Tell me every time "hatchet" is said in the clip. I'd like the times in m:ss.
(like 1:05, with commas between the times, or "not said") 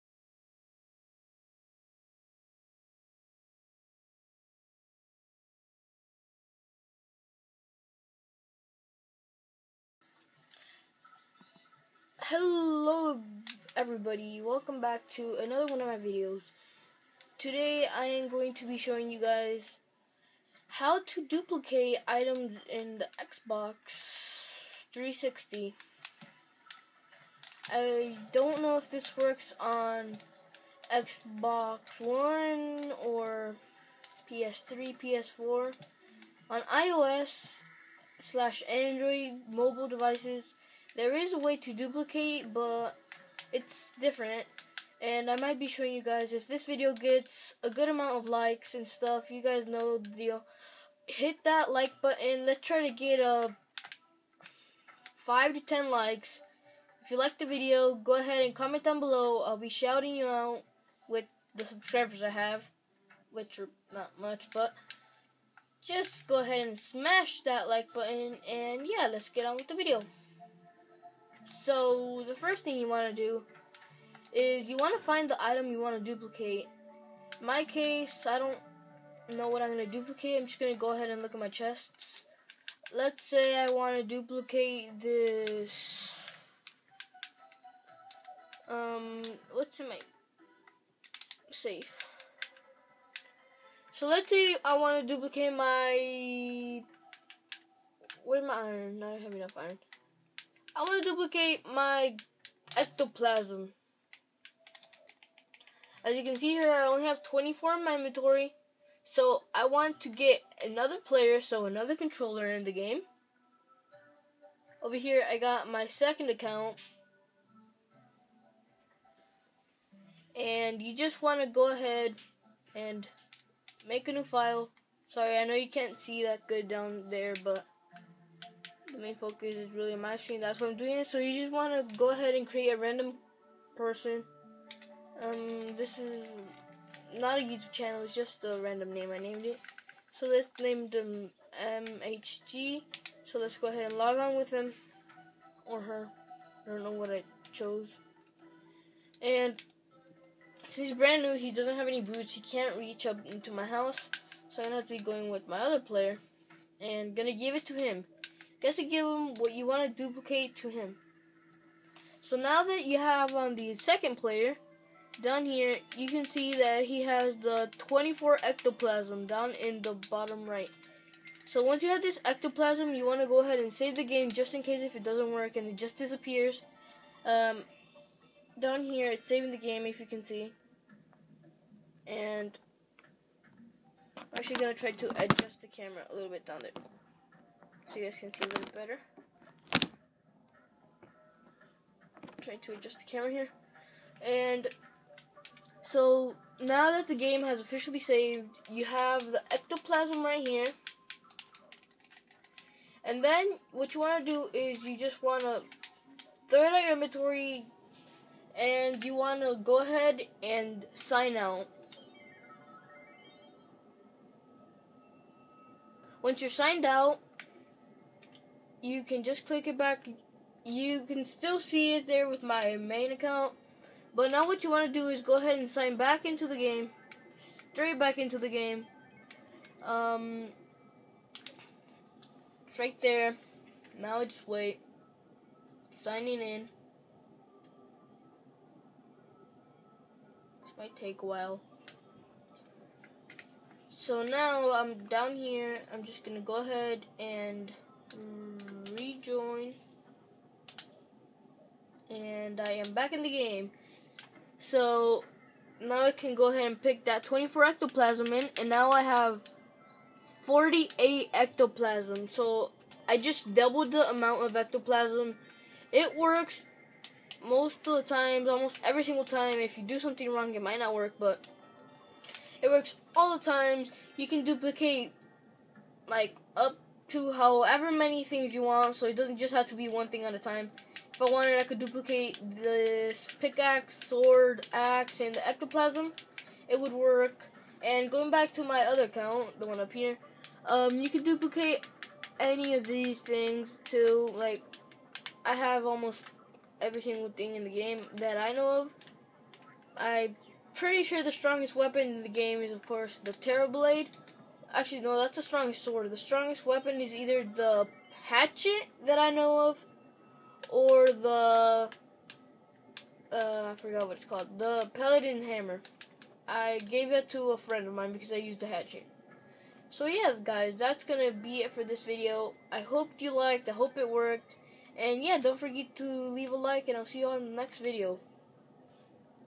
5:08, 5:18.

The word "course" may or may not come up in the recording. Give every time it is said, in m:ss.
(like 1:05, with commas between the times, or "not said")
5:02.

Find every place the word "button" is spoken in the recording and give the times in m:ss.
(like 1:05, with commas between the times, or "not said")
0:52, 1:07.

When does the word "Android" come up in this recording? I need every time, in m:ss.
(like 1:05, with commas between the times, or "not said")
0:38.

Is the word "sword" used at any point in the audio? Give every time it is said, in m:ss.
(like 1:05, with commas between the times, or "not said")
4:44, 5:05.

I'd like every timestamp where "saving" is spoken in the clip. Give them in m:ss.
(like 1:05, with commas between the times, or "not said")
2:59.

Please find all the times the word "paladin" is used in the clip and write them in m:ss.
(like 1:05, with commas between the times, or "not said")
5:14.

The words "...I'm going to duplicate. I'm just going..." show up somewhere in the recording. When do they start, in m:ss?
1:19.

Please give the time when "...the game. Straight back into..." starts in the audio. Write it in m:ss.
3:46.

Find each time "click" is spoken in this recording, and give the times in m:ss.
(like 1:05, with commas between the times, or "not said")
3:39.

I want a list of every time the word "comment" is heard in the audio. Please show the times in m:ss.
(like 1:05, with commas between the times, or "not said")
0:58.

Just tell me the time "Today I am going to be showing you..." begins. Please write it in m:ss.
0:17.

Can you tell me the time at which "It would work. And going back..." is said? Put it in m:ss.
4:46.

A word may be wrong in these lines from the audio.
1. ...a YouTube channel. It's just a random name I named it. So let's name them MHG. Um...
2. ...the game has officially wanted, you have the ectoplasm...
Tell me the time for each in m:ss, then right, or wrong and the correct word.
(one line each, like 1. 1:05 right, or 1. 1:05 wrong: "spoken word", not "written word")
1. 2:17 right
2. 3:17 wrong: "saved", not "wanted".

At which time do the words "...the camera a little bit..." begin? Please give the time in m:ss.
3:05.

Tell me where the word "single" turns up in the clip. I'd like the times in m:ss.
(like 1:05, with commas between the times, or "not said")
4:29, 4:57.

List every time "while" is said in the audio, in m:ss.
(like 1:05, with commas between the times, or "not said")
4:01.